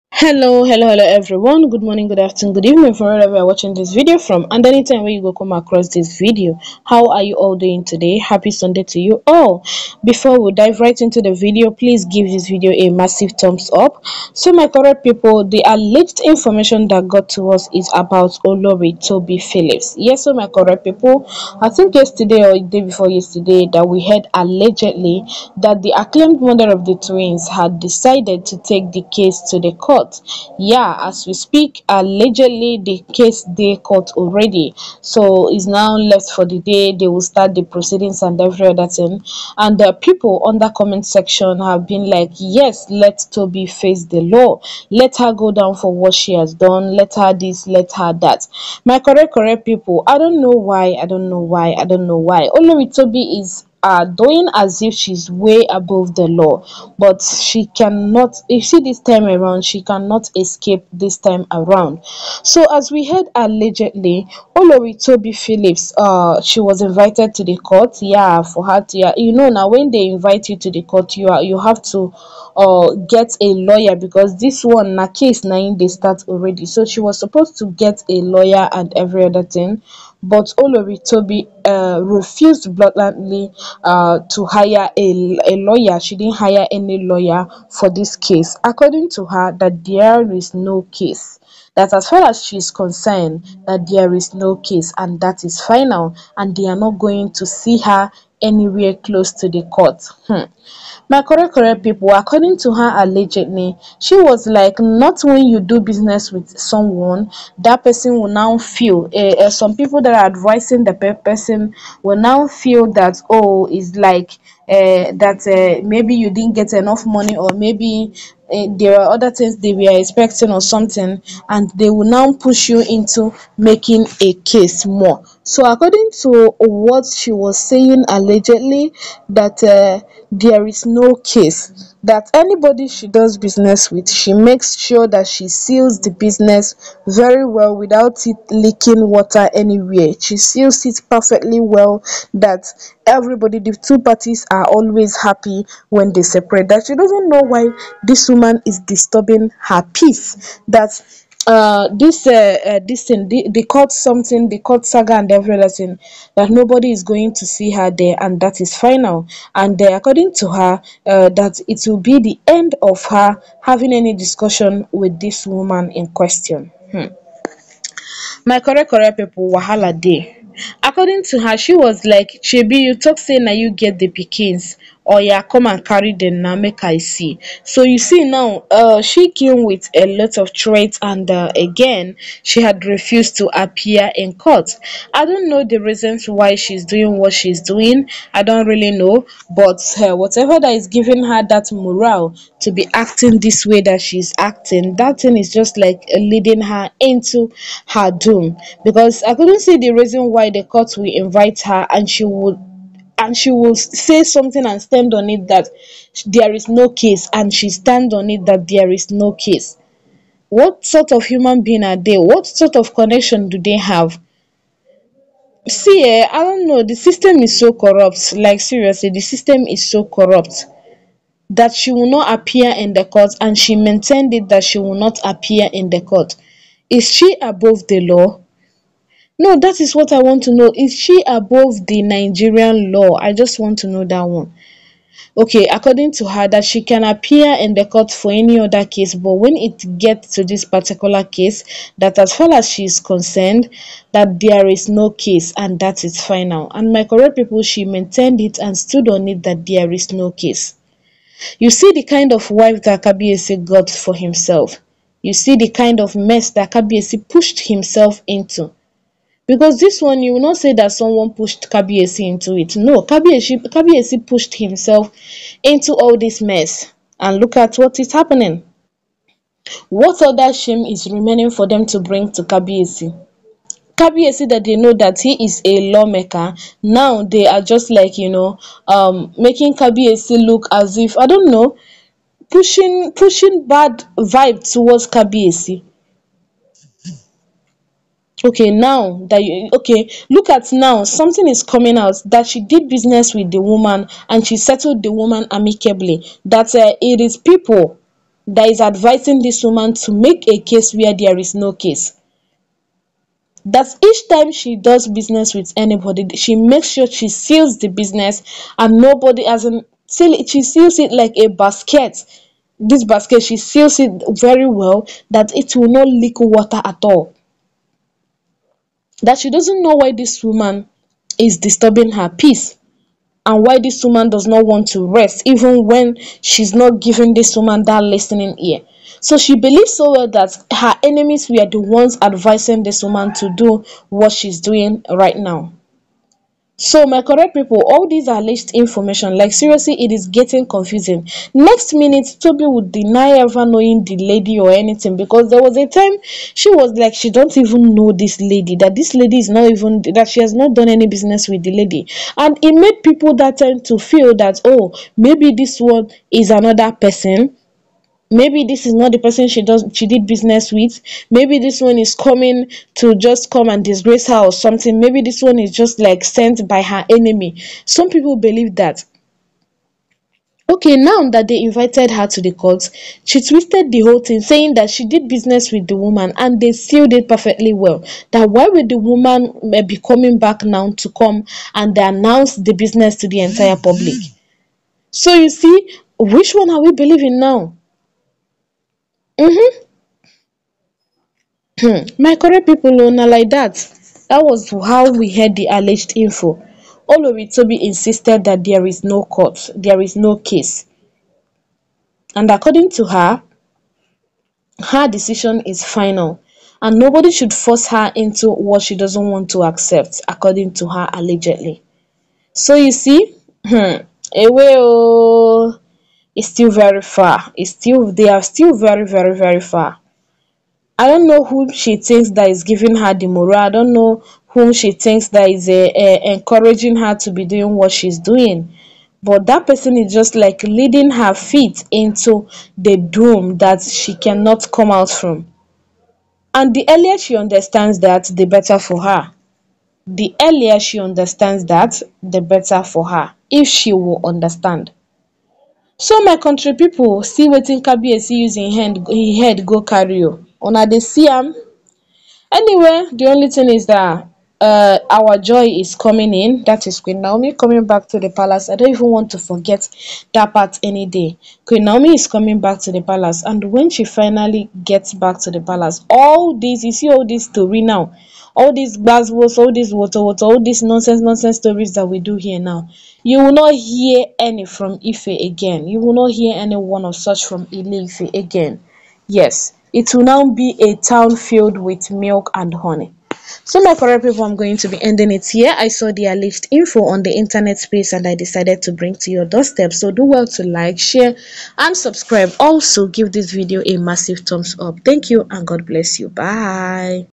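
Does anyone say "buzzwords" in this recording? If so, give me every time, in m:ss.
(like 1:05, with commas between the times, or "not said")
7:48.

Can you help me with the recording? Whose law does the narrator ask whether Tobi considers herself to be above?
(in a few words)
Nigerian law.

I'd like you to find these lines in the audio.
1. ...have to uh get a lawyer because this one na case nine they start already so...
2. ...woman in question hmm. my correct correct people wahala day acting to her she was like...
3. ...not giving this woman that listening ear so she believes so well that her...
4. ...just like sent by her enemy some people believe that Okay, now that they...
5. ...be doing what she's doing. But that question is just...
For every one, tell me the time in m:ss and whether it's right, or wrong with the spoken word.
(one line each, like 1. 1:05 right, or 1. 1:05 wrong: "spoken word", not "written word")
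1. 1:11 right
2. 2:45 wrong: "according", not "acting"
3. 5:26 right
4. 6:05 right
5. 7:07 wrong: "person", not "question".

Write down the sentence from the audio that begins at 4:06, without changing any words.
And my correct people, she maintained it and stood on it that there is no case.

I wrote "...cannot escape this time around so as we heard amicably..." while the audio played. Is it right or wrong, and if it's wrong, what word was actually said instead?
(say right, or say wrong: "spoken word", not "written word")
wrong: "allegedly", not "amicably".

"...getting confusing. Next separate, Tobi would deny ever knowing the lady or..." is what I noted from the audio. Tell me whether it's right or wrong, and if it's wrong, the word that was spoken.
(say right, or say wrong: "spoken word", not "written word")
wrong: "minute", not "separate".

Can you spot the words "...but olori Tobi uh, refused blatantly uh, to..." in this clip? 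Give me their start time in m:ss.
1:20.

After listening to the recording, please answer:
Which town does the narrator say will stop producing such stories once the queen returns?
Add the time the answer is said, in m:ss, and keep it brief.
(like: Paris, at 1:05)
Ile Ife, at 7:57.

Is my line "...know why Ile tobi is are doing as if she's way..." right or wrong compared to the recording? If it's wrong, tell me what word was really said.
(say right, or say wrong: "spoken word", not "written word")
wrong: "Only", not "Ile".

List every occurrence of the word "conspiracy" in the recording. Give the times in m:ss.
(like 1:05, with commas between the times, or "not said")
not said.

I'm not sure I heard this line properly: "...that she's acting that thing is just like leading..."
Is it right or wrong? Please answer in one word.
right.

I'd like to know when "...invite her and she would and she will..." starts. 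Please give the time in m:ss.
3:21.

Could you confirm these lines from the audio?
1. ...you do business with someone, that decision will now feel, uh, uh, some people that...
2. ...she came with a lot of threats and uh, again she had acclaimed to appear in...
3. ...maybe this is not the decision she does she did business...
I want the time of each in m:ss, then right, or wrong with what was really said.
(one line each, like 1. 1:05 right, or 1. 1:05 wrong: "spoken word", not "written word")
1. 1:45 wrong: "person", not "decision"
2. 2:59 wrong: "refused", not "acclaimed"
3. 5:58 wrong: "person", not "decision".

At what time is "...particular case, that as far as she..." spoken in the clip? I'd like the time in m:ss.
4:00.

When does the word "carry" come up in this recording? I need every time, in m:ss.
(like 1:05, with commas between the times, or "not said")
2:55, 7:29.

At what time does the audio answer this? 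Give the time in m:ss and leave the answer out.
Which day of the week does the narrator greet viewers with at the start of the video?
0:08.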